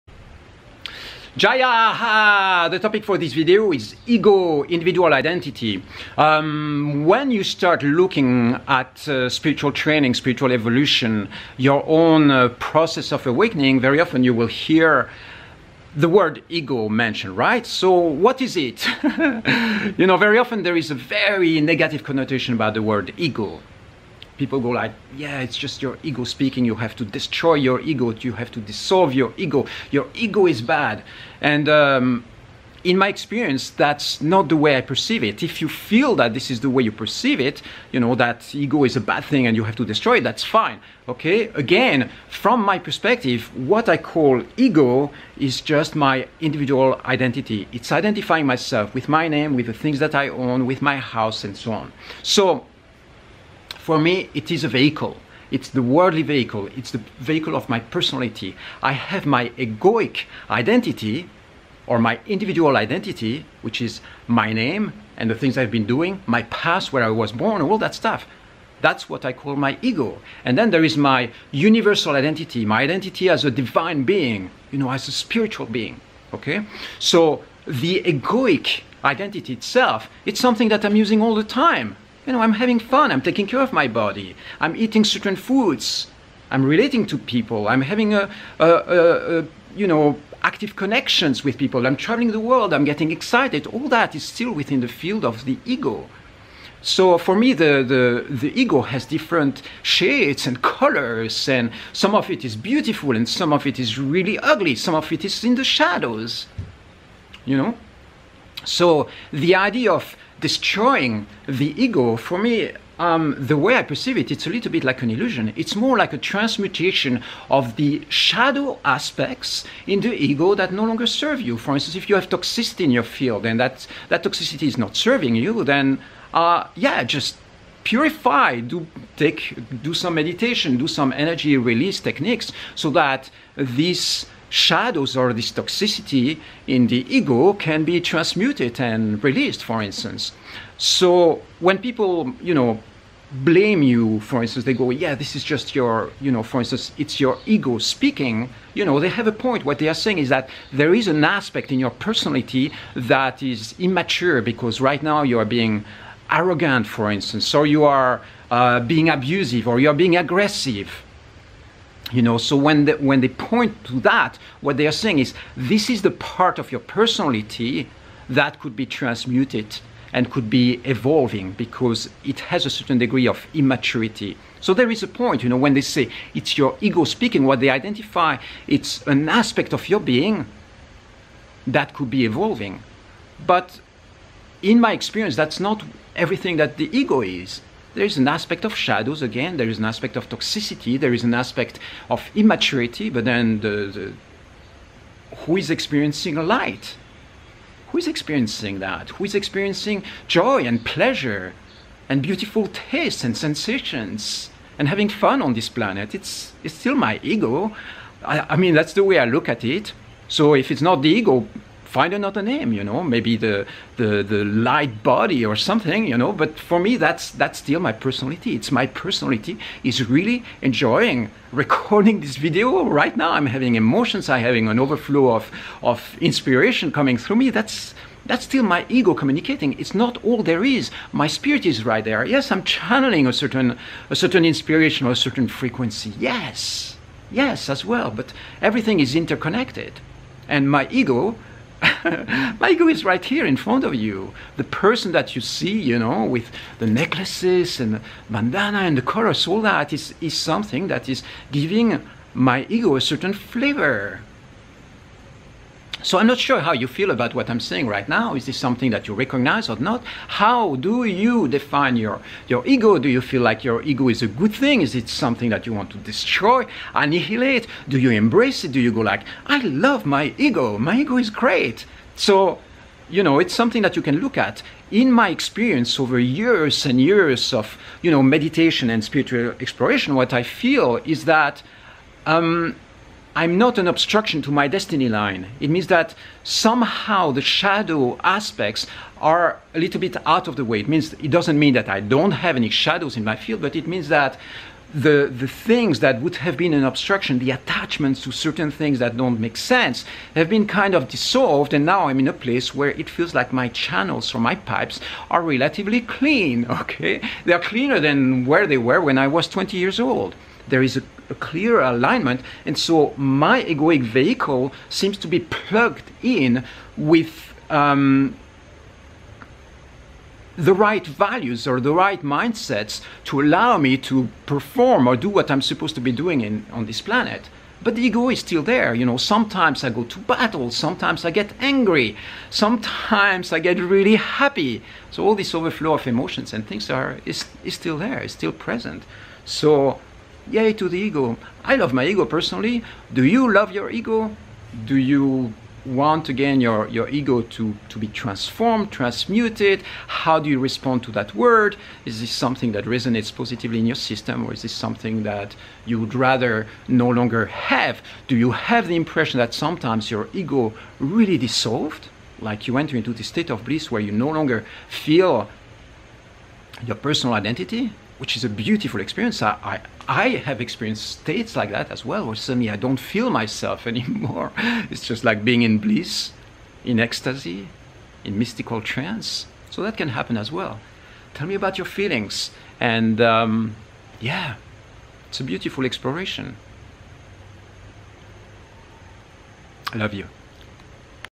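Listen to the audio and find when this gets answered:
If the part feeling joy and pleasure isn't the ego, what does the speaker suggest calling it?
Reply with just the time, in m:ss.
3:34.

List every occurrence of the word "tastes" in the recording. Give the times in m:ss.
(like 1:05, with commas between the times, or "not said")
3:22.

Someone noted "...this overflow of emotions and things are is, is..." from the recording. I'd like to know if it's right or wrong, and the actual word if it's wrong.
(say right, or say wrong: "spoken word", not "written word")
right.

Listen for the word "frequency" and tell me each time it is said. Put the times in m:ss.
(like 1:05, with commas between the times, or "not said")
3:55.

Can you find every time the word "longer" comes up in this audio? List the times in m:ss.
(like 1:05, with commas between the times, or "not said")
2:00, 5:57, 6:04.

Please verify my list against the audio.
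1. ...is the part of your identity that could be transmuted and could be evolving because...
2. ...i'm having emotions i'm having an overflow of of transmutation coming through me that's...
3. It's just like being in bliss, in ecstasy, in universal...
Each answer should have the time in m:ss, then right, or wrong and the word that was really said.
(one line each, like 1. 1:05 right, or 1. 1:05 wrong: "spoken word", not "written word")
1. 2:45 wrong: "personality", not "identity"
2. 3:43 wrong: "inspiration", not "transmutation"
3. 6:14 wrong: "mystical", not "universal".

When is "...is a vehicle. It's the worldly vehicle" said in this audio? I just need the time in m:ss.
0:54.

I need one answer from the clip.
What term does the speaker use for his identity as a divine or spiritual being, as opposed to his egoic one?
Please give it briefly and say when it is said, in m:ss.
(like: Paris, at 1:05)
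universal identity, at 1:11.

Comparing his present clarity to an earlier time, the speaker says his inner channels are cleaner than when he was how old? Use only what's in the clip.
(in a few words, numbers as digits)
20.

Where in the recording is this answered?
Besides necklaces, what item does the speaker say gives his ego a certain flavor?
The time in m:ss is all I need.
4:08.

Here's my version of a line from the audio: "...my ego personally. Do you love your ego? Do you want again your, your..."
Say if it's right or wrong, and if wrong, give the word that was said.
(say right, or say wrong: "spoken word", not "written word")
right.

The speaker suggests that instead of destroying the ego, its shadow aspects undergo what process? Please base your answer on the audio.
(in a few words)
transmutation.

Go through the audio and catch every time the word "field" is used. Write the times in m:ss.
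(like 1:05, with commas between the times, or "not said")
1:34, 2:03, 4:53.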